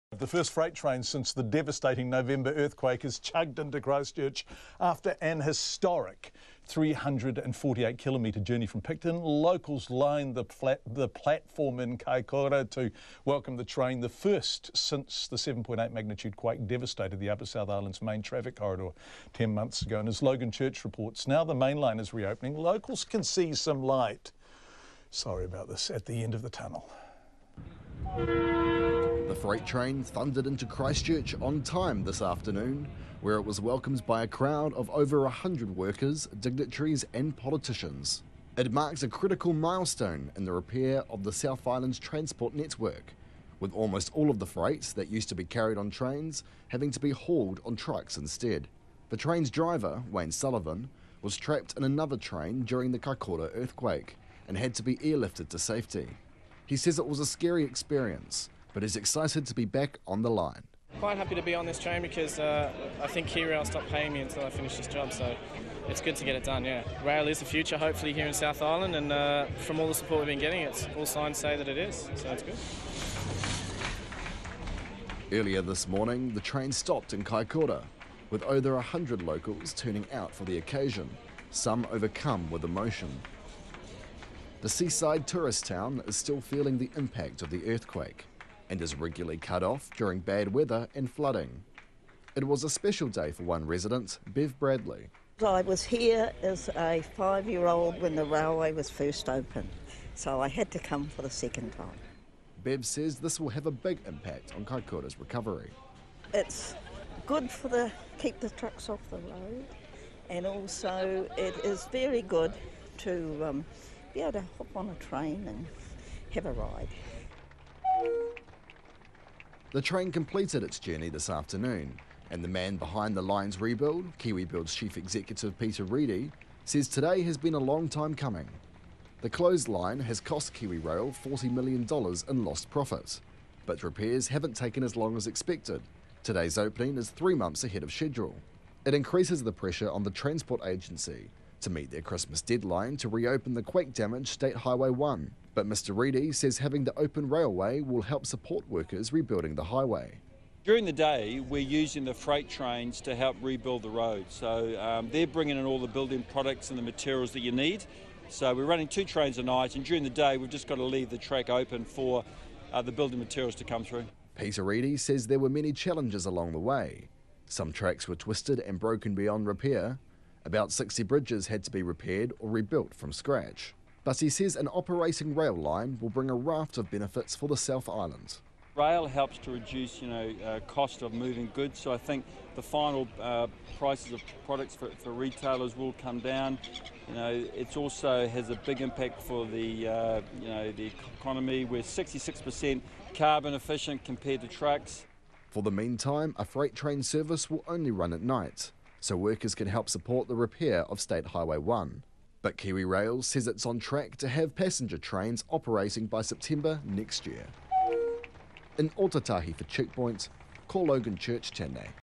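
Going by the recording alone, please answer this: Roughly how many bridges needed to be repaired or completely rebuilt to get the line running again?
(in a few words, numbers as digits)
60.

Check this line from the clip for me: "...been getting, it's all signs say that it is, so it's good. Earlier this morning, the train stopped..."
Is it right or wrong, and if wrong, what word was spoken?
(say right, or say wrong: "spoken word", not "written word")
right.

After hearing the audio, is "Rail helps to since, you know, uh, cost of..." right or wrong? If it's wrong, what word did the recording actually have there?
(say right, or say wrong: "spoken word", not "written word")
wrong: "reduce", not "since".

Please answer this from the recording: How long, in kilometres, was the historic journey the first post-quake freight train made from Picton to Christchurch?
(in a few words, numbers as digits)
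348 kilometres.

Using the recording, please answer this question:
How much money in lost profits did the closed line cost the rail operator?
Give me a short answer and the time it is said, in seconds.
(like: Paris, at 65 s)
$40 million, at 131 s.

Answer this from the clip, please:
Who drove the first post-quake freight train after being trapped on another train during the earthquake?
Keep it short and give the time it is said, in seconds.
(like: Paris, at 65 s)
Wayne Sullivan, at 50 s.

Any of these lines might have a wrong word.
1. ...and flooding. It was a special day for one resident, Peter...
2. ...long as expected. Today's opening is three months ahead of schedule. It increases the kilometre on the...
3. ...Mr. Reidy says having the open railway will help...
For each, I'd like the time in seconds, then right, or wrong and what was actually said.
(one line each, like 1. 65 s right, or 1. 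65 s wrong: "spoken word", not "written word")
1. 90 s wrong: "Bev", not "Peter"
2. 134 s wrong: "pressure", not "kilometre"
3. 145 s right.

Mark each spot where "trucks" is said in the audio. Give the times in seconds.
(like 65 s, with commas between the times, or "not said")
47 s, 108 s, 194 s.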